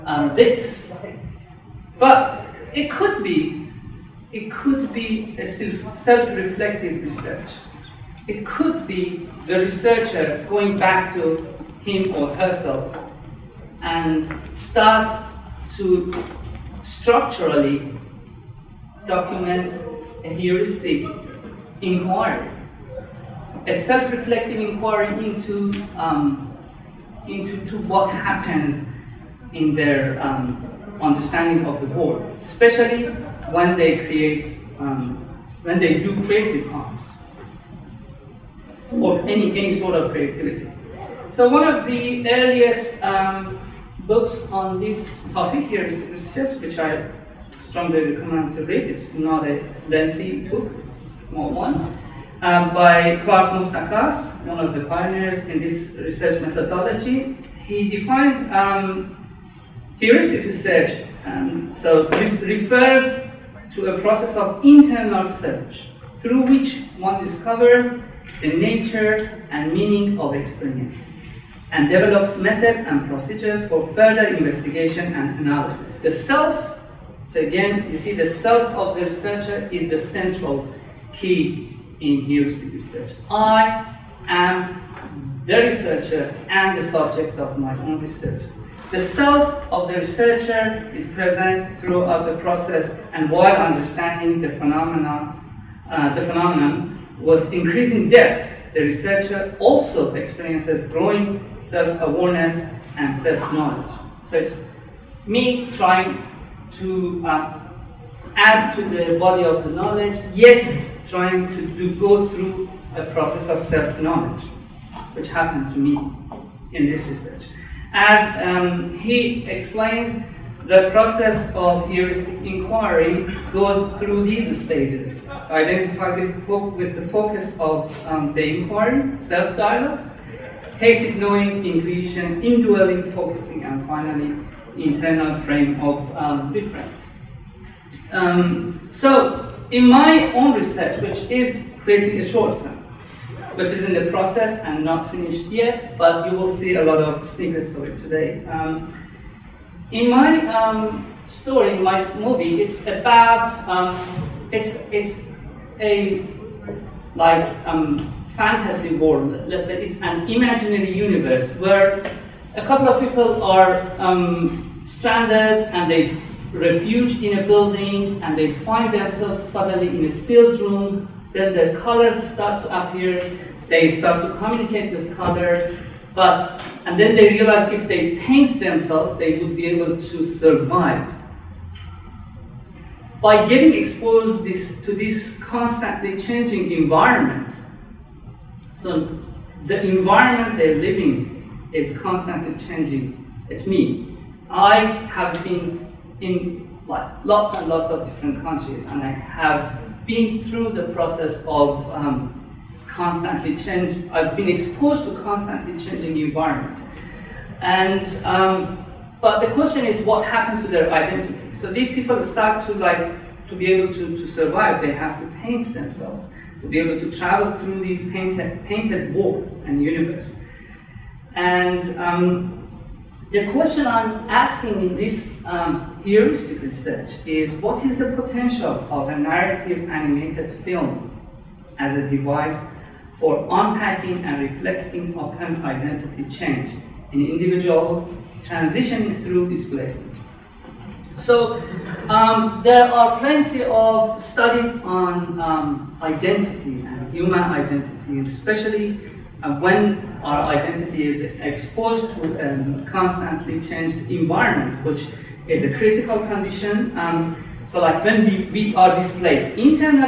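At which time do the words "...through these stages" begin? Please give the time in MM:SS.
02:03.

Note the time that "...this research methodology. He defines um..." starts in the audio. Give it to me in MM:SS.
00:55.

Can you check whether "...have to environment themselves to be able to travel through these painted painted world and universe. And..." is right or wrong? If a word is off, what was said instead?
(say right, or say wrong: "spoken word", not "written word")
wrong: "paint", not "environment".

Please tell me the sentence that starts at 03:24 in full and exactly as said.
I've been exposed to constantly changing environments.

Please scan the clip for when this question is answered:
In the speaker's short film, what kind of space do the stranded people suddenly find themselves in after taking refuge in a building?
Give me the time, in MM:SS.
02:50.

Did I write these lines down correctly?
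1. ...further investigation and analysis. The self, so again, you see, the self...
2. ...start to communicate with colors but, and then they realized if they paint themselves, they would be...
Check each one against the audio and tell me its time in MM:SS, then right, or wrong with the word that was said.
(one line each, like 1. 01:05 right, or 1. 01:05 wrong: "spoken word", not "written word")
1. 01:13 right
2. 02:53 right.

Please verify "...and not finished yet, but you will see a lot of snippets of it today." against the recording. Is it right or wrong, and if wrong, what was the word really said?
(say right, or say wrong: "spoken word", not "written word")
right.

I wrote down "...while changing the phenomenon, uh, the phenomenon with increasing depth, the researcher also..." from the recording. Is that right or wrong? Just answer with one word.
wrong.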